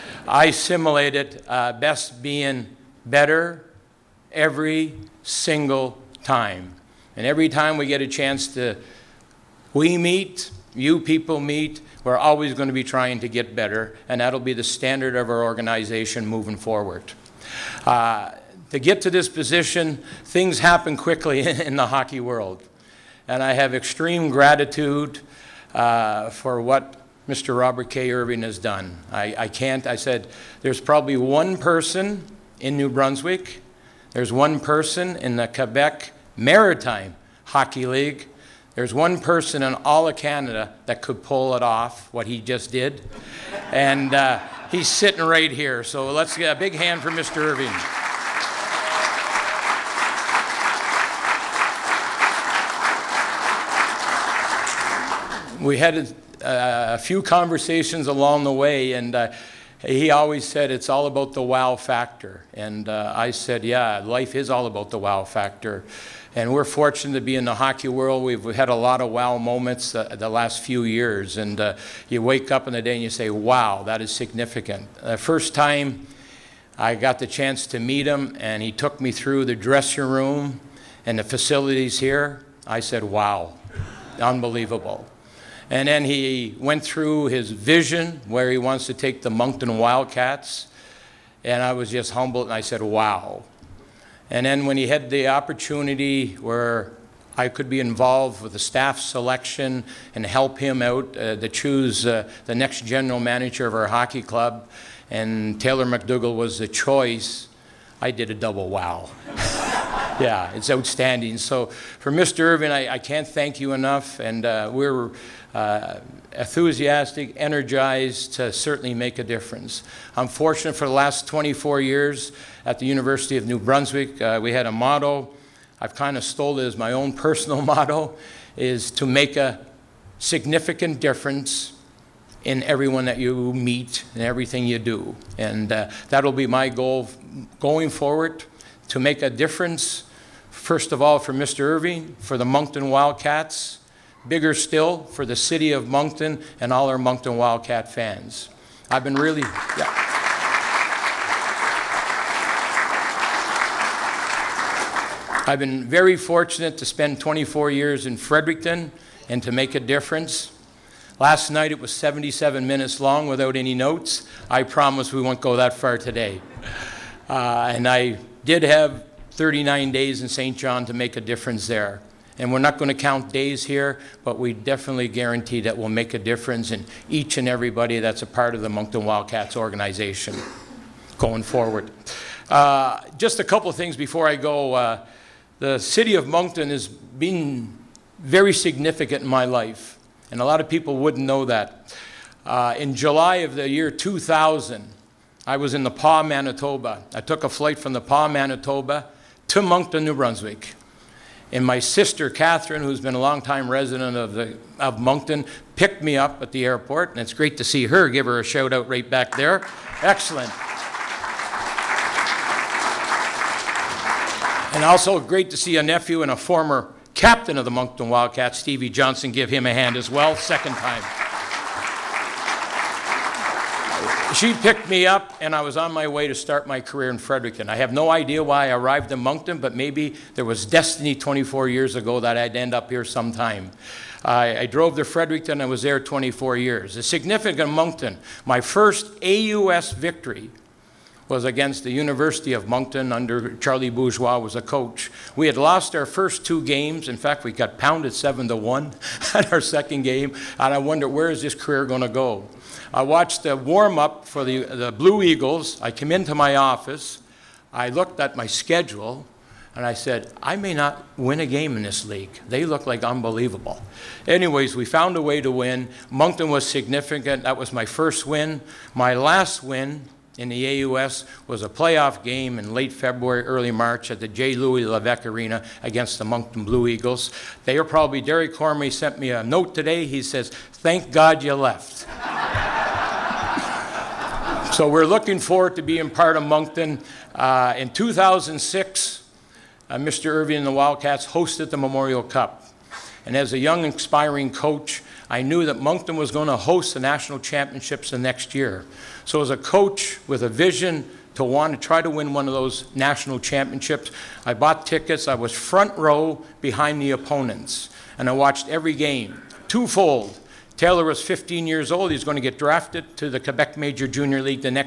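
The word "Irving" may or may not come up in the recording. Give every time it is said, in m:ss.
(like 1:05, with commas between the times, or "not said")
0:28, 0:47, 1:52, 2:21, 4:50.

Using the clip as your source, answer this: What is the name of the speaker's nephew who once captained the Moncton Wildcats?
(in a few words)
Stevie Johnson.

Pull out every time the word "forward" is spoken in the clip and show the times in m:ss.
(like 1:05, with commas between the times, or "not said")
0:16, 2:17, 3:01, 4:45.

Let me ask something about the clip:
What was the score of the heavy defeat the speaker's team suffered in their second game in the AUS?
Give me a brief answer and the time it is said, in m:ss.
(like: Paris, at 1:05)
7-1, at 4:08.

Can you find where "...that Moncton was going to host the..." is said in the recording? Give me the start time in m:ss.
4:55.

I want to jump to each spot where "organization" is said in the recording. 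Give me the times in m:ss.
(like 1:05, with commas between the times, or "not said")
0:15, 2:59.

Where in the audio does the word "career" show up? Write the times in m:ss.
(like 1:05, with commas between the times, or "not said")
3:46, 4:11.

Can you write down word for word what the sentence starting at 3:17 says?
I took a flight from the Pas, Manitoba to Moncton, New Brunswick.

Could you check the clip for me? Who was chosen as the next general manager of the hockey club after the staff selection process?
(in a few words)
Taylor MacDougall.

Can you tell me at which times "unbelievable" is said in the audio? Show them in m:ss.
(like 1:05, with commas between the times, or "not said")
1:24, 4:23.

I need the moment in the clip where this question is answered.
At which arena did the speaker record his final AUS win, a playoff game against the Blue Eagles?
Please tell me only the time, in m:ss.
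4:34.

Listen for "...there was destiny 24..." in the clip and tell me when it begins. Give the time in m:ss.
3:50.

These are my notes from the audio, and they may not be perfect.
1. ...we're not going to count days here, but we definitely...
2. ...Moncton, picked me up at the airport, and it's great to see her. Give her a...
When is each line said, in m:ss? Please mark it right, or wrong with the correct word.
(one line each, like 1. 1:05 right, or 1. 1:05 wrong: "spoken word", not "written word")
1. 2:52 right
2. 3:24 right.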